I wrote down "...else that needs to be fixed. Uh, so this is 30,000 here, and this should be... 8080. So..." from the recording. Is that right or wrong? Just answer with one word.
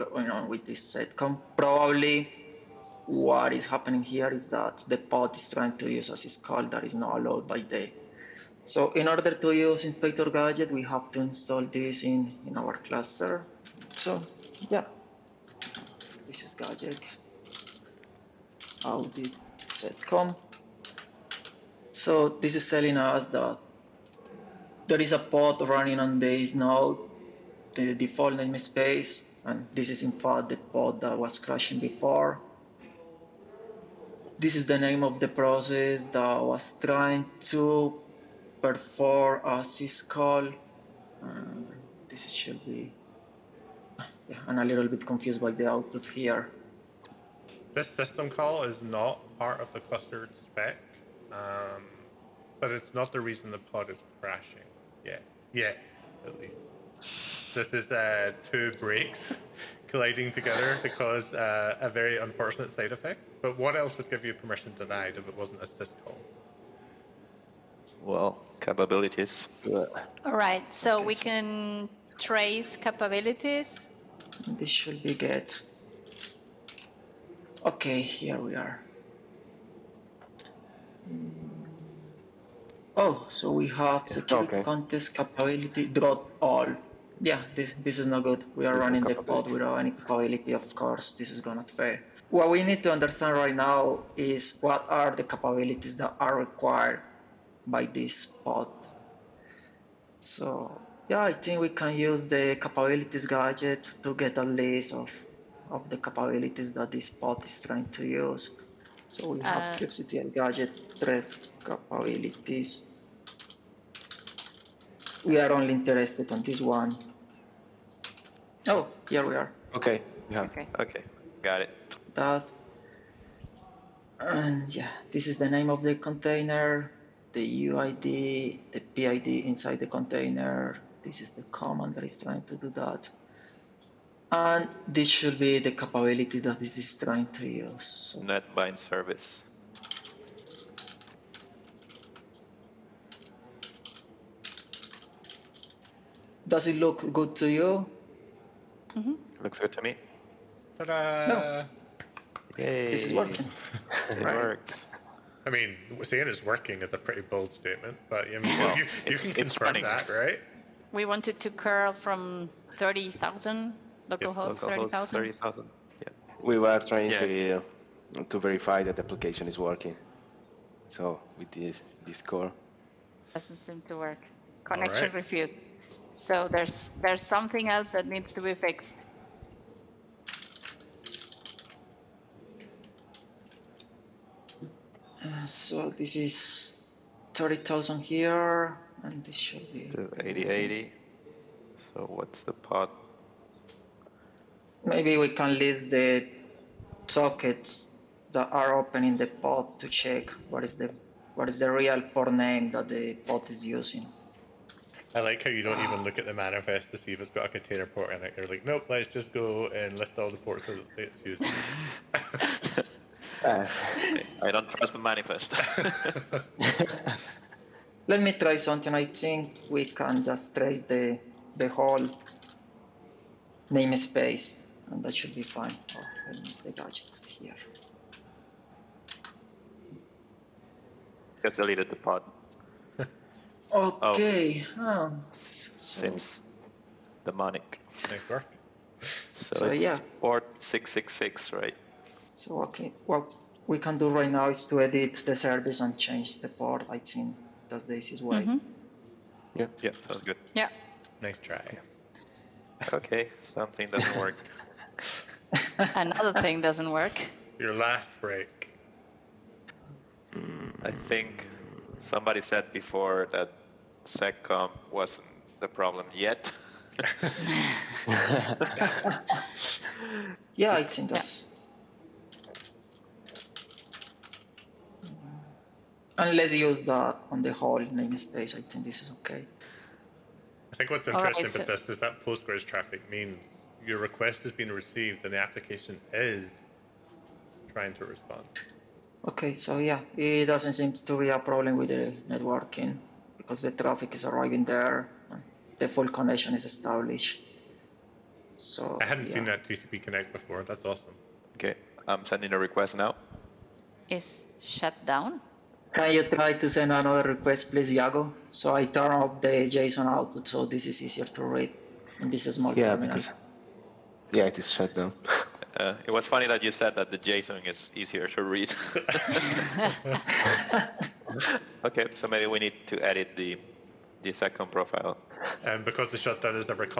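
right.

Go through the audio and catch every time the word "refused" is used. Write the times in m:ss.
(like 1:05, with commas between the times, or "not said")
2:55.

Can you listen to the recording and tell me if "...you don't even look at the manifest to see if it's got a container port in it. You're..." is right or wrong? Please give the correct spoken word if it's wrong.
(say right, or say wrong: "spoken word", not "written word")
right.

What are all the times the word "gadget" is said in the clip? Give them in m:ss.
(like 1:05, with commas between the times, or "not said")
0:10, 0:16, 1:43, 1:50, 3:46.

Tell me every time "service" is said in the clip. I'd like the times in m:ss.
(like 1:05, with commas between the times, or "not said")
2:18, 4:05.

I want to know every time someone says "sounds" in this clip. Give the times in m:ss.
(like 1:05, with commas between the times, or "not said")
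4:09.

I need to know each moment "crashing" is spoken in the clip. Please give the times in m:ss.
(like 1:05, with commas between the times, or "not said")
0:31, 0:54.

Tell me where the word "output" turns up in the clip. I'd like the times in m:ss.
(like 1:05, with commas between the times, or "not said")
0:45, 5:10.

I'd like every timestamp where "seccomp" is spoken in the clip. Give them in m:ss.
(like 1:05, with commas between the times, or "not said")
0:00, 0:19, 4:24, 5:24.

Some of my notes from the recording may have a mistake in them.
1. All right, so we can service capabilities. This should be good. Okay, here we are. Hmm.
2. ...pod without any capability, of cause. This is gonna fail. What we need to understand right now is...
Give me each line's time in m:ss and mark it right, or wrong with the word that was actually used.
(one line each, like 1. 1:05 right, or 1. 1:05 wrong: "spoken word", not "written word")
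1. 1:10 wrong: "trace", not "service"
2. 1:29 wrong: "course", not "cause".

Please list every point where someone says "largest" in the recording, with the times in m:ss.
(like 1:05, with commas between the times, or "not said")
not said.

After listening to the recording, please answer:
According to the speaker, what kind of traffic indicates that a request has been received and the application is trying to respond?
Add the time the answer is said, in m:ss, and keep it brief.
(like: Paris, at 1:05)
Postgres traffic, at 4:42.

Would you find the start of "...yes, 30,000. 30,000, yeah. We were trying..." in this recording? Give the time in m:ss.
2:44.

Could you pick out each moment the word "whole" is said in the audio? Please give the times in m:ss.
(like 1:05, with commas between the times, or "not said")
3:41, 4:37.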